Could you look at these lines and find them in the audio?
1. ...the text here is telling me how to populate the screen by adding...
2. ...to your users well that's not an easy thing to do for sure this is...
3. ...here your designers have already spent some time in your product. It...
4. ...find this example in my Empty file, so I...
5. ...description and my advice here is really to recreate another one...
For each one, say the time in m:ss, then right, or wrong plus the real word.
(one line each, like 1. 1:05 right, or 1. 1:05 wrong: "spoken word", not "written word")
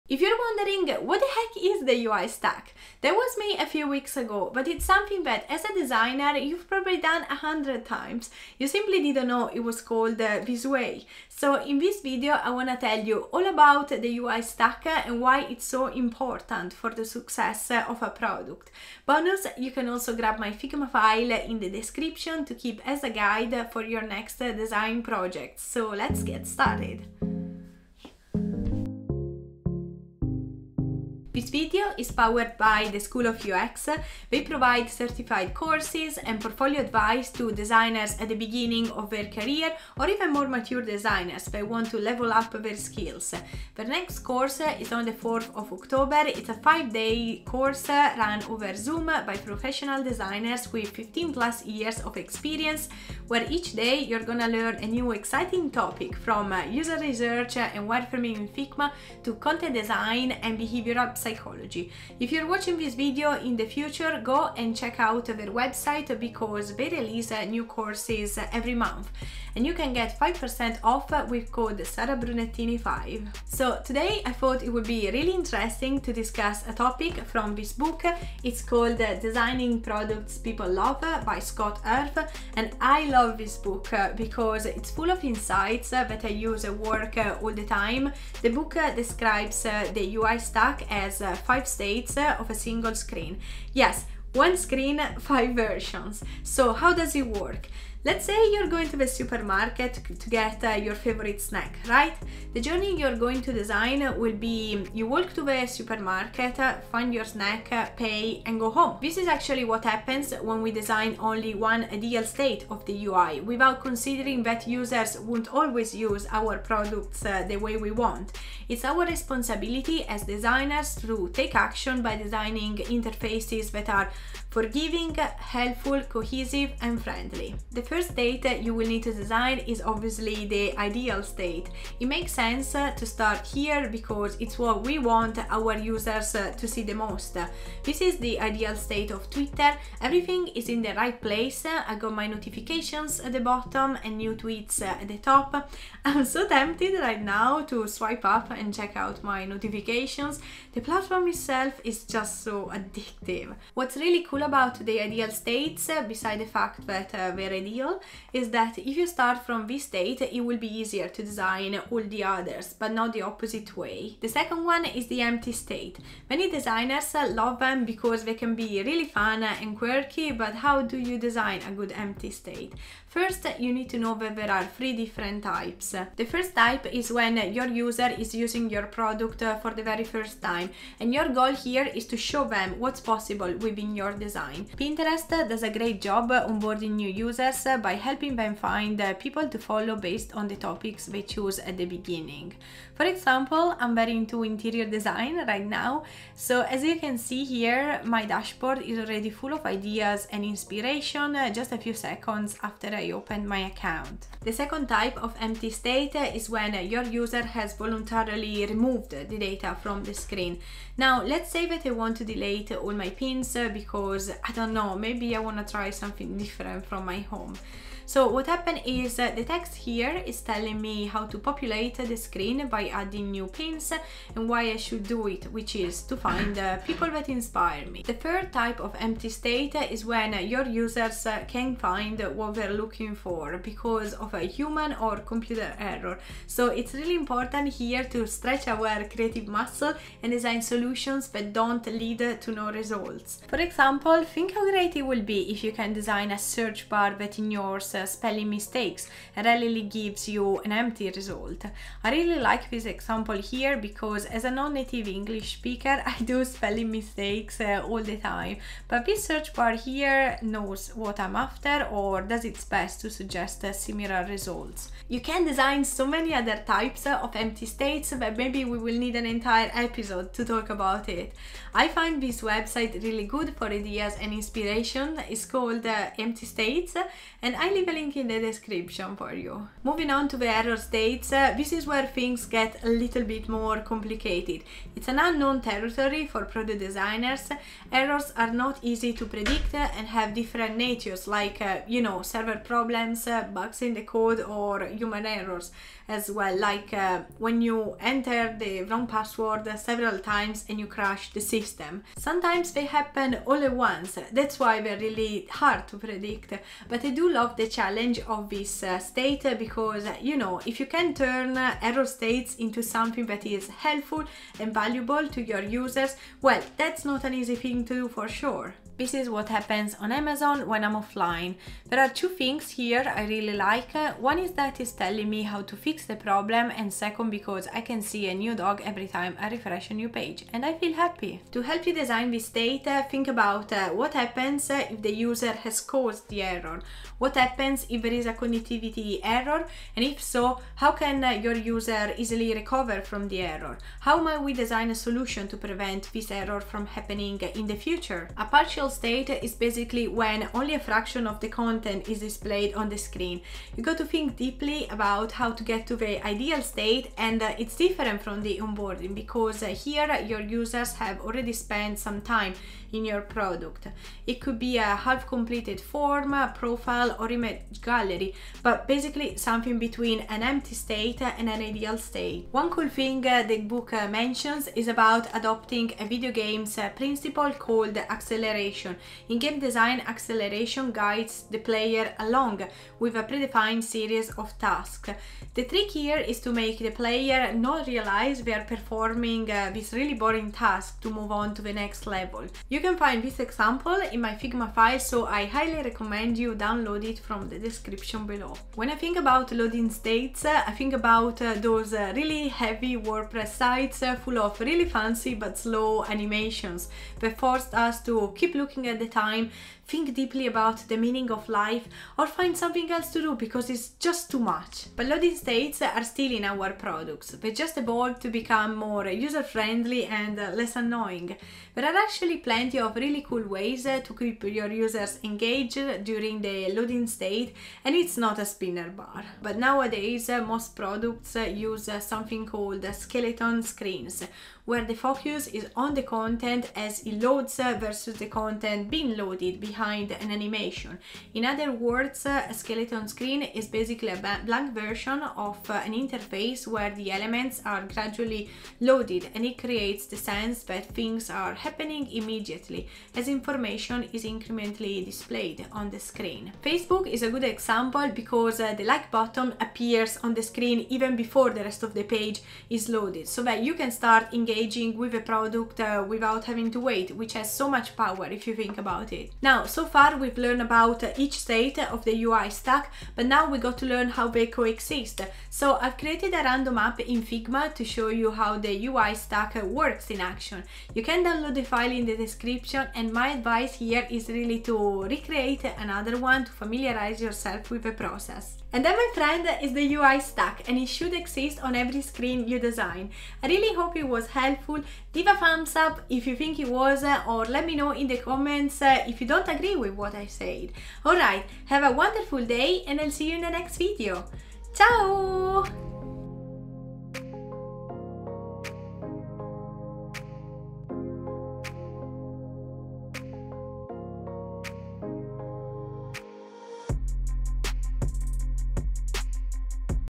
1. 3:39 right
2. 5:15 right
3. 5:59 wrong: "users", not "designers"
4. 6:32 wrong: "Figma", not "Empty"
5. 8:02 right.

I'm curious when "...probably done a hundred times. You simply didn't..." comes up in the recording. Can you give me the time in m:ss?
0:06.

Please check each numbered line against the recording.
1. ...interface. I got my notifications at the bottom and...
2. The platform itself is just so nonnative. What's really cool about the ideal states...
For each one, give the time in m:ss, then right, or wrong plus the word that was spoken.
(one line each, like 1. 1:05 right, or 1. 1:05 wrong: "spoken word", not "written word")
1. 2:21 wrong: "place", not "interface"
2. 2:30 wrong: "addictive", not "nonnative".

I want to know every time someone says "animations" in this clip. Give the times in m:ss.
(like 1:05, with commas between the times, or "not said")
6:46, 7:20.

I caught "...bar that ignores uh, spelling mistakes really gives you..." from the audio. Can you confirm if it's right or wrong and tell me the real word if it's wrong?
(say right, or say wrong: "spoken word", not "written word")
right.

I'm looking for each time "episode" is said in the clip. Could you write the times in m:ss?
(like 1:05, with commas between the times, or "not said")
4:29.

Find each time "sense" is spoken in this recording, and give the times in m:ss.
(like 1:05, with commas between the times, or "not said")
2:12, 7:30.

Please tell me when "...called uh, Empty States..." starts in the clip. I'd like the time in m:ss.
4:35.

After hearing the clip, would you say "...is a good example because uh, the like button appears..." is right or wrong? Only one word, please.
right.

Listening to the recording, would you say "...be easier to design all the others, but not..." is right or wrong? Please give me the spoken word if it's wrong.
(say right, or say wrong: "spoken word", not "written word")
right.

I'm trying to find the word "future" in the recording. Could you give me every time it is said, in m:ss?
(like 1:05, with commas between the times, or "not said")
1:03, 5:47.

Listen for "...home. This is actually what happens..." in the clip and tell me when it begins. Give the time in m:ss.
1:48.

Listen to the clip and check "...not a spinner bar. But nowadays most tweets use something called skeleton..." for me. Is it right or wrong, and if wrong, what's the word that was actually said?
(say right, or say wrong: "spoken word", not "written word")
wrong: "products", not "tweets".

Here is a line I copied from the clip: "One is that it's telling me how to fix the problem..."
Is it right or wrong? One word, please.
right.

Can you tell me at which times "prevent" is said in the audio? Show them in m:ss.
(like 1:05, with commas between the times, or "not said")
5:45.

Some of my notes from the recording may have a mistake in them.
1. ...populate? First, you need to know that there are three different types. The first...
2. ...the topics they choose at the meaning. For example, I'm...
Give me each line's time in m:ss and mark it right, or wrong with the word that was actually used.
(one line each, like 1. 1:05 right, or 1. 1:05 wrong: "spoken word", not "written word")
1. 2:52 wrong: "state", not "populate"
2. 3:10 wrong: "beginning", not "meaning".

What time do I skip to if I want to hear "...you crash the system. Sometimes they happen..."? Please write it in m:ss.
5:00.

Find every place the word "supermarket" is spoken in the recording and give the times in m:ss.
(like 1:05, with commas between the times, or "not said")
1:39, 1:45.